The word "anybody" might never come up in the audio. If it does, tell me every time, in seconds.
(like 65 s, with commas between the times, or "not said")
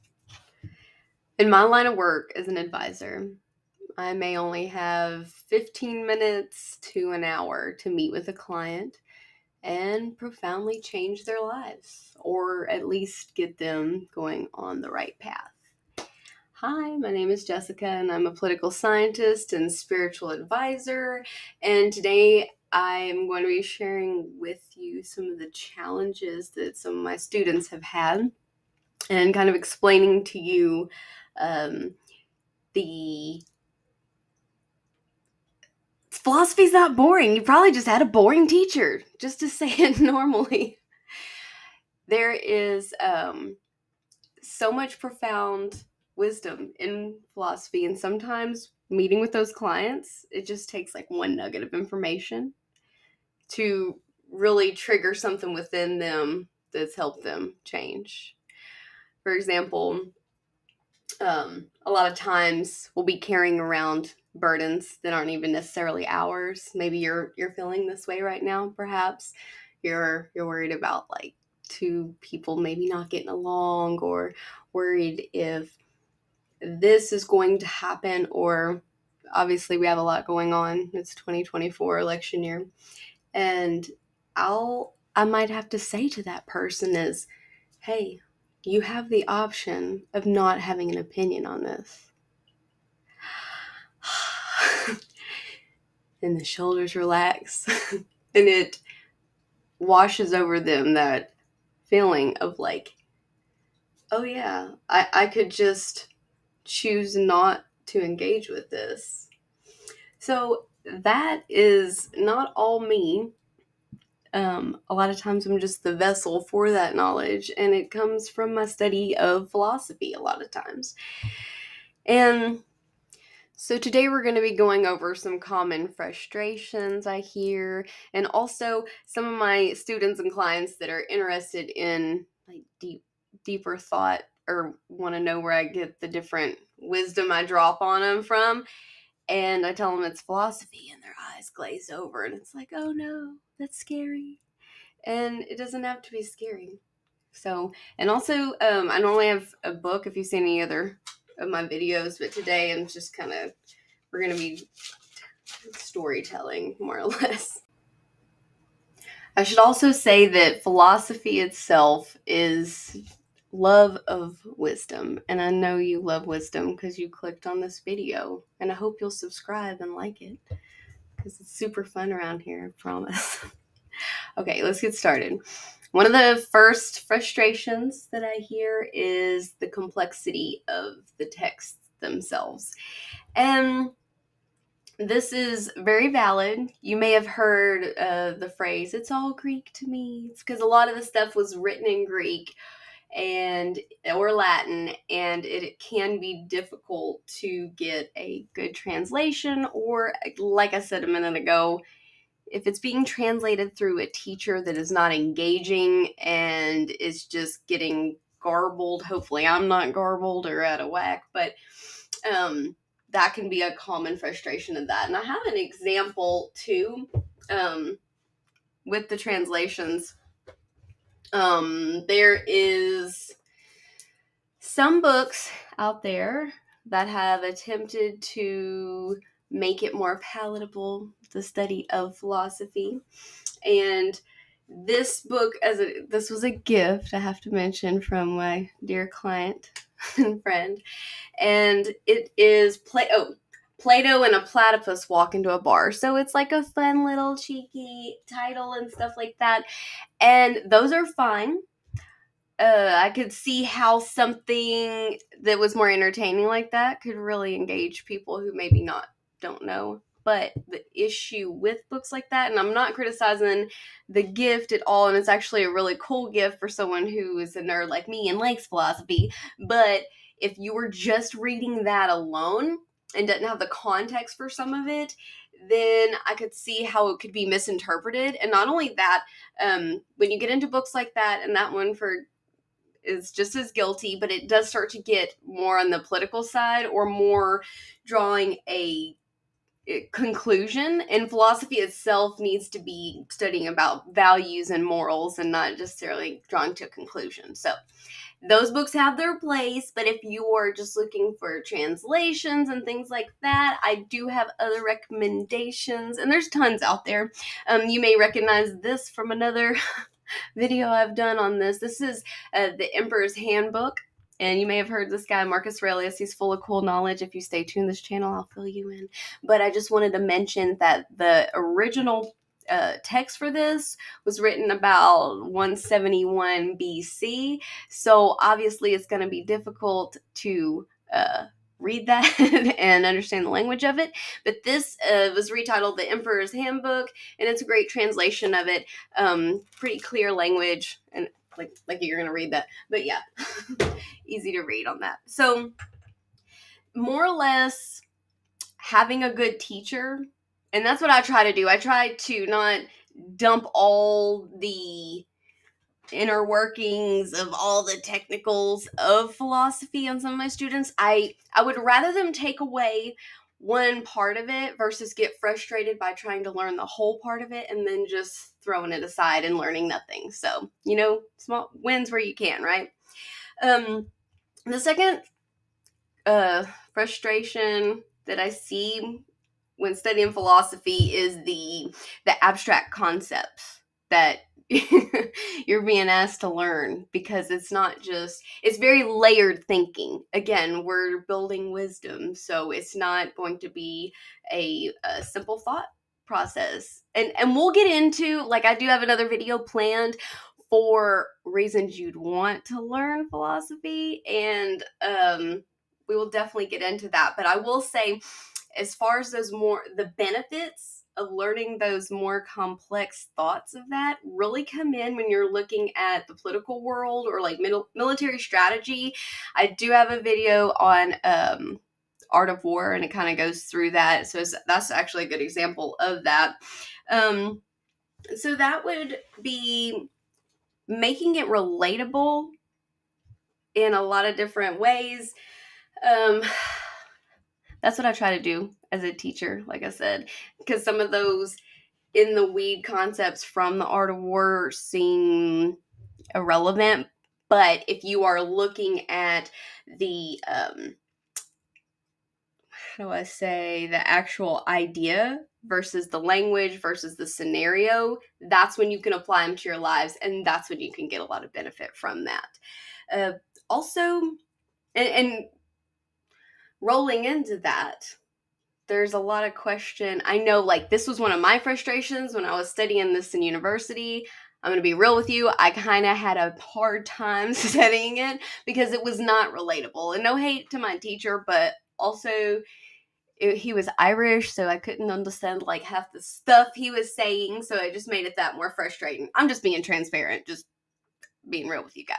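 not said.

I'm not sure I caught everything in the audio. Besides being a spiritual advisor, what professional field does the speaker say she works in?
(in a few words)
Political scientist.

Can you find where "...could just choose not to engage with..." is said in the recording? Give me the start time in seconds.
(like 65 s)
105 s.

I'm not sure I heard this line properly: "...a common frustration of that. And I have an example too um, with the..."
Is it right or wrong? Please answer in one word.
right.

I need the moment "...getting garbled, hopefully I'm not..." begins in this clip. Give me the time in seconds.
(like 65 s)
207 s.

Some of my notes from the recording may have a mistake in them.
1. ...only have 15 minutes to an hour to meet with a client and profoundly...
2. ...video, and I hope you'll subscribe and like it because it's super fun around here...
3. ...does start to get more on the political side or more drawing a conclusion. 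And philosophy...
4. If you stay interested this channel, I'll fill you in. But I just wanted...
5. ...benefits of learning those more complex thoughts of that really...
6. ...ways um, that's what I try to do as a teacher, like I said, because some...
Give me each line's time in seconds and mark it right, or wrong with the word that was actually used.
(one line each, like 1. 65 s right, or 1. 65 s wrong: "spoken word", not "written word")
1. 4 s right
2. 167 s right
3. 284 s right
4. 317 s wrong: "tuned", not "interested"
5. 410 s right
6. 434 s right.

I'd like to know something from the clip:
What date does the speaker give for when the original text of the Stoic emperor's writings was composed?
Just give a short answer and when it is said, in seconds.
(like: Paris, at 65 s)
171 BC, at 325 s.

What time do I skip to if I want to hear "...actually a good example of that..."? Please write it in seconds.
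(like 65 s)
424 s.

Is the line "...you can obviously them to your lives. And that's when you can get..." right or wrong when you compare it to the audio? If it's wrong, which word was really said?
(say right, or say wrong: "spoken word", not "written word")
wrong: "apply", not "obviously".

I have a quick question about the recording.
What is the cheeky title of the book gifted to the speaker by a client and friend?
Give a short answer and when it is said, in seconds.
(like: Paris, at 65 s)
Plato and a Platypus Walk into a Bar, at 243 s.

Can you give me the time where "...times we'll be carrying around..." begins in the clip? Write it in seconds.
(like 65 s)
62 s.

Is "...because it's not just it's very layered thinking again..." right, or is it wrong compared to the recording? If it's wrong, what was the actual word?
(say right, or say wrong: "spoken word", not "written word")
right.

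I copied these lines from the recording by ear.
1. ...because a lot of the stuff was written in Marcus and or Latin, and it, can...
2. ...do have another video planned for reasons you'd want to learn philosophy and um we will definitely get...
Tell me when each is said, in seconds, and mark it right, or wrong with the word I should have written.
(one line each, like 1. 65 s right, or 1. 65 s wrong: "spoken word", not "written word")
1. 190 s wrong: "Greek", not "Marcus"
2. 398 s right.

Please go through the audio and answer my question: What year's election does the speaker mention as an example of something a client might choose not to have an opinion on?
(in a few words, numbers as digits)
2024.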